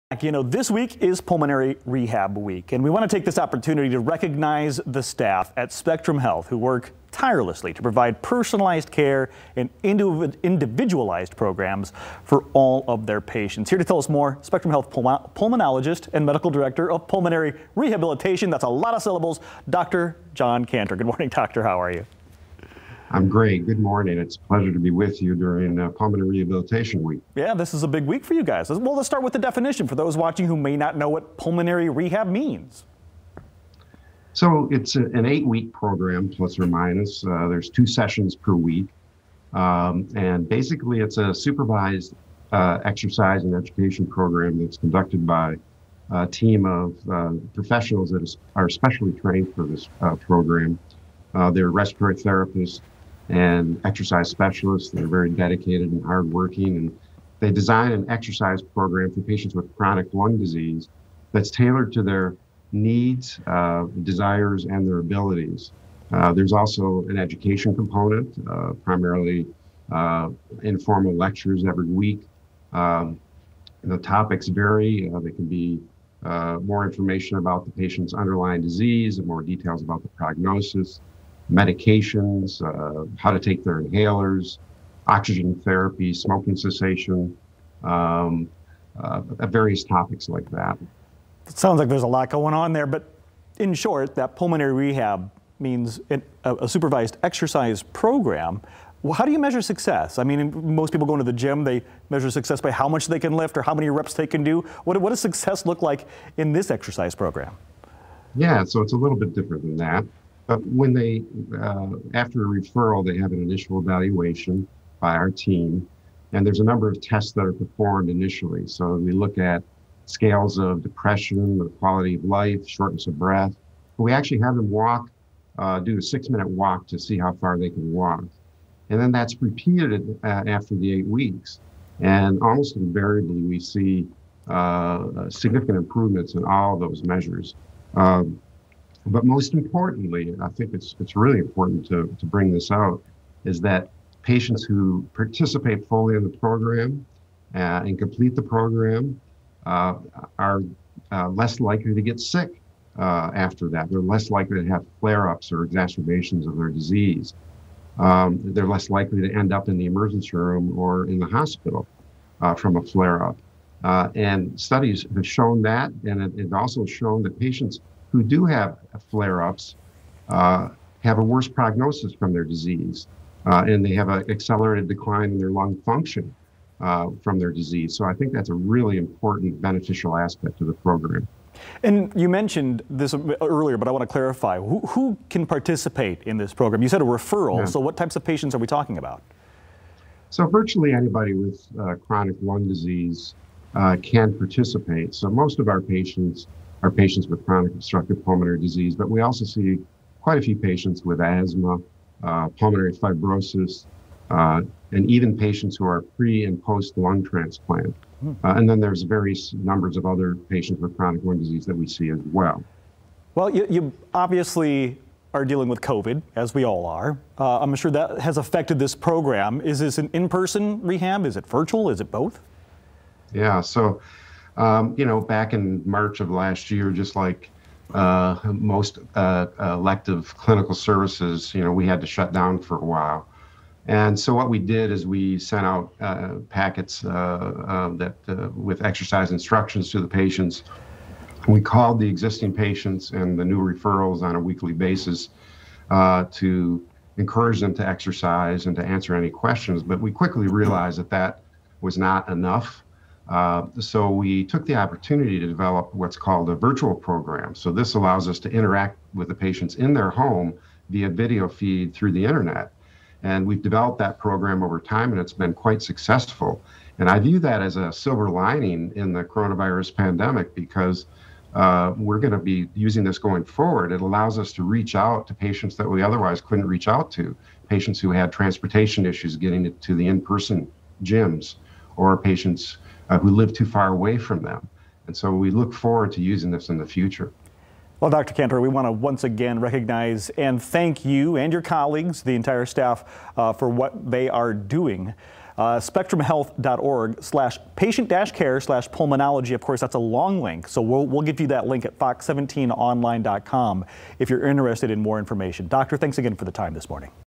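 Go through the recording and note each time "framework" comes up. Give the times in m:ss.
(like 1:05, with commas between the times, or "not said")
not said.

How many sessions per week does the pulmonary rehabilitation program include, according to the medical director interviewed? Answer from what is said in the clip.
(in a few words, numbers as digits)
2.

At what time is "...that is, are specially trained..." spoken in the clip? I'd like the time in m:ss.
0:48.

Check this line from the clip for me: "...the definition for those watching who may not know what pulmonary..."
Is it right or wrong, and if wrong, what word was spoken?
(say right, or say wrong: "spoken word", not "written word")
right.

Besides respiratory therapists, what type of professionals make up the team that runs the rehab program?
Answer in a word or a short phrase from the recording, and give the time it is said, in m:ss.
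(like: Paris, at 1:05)
Exercise specialists, at 0:53.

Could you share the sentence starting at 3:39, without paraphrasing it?
Is this an in person rehab?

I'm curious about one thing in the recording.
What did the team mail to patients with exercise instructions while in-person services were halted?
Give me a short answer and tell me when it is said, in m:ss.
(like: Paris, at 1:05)
Packets, at 3:56.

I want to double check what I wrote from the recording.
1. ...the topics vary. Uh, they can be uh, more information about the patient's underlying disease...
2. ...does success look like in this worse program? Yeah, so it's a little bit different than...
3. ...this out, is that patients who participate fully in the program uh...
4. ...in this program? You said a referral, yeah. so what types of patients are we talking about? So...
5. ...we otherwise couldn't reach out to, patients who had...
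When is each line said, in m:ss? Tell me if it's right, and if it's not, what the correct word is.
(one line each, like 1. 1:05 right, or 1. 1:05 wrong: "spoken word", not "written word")
1. 1:13 right
2. 1:45 wrong: "exercise", not "worse"
3. 2:22 right
4. 3:06 right
5. 4:35 right.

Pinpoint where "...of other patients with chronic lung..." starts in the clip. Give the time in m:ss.
3:29.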